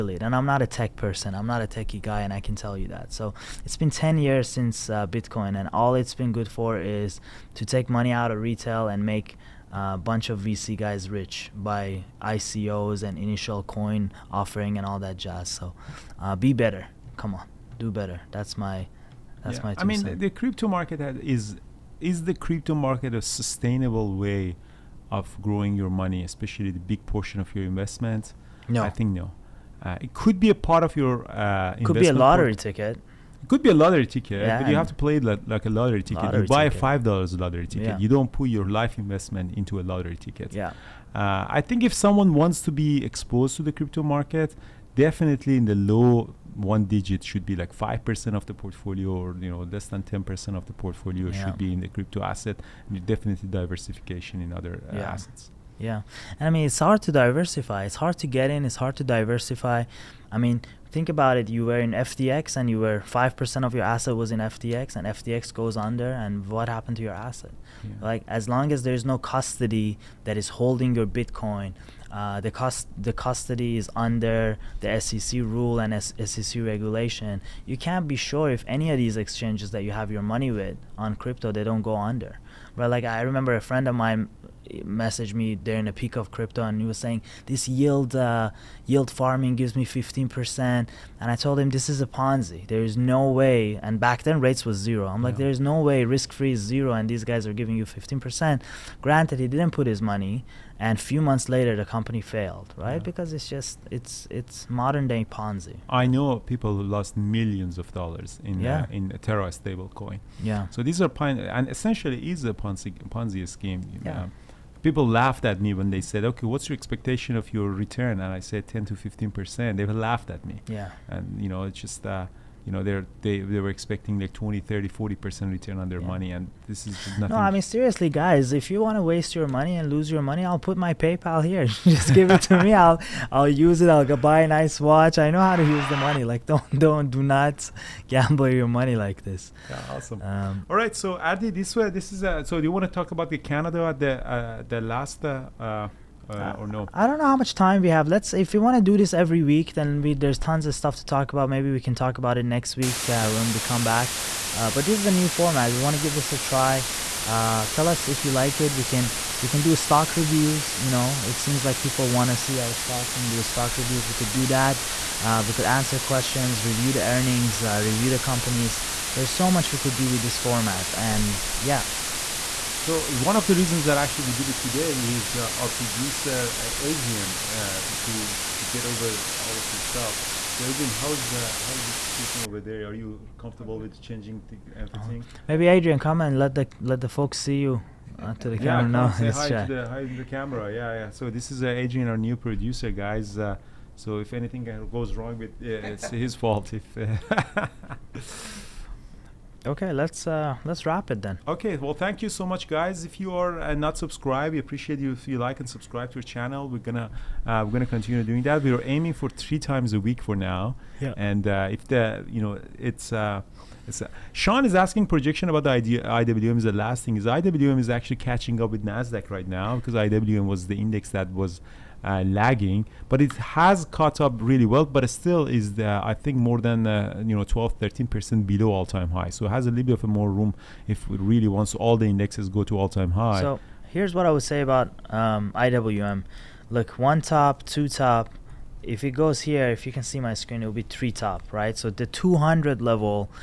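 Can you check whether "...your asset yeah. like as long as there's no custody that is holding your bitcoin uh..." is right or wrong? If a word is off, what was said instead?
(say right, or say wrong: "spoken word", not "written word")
right.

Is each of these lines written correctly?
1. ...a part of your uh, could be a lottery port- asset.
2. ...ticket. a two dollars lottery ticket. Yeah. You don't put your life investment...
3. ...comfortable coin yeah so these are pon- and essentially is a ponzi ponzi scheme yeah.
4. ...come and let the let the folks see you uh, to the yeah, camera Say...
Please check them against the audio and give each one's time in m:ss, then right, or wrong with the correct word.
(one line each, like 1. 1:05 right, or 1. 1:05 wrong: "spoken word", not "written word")
1. 0:30 wrong: "ticket", not "asset"
2. 0:36 wrong: "five", not "two"
3. 1:49 wrong: "stable", not "comfortable"
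4. 3:05 right.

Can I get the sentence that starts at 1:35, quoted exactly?
I'm like there is no way risk free is zero and these guys are giving you 15%.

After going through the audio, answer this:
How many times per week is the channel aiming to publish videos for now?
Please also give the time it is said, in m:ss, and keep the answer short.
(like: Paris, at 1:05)
3, at 3:29.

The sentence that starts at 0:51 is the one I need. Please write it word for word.
should be in the crypto asset and definitely diversification in other uh, yeah.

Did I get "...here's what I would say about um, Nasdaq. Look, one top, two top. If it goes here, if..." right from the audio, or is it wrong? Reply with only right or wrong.
wrong.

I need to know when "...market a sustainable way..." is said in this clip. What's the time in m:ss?
0:22.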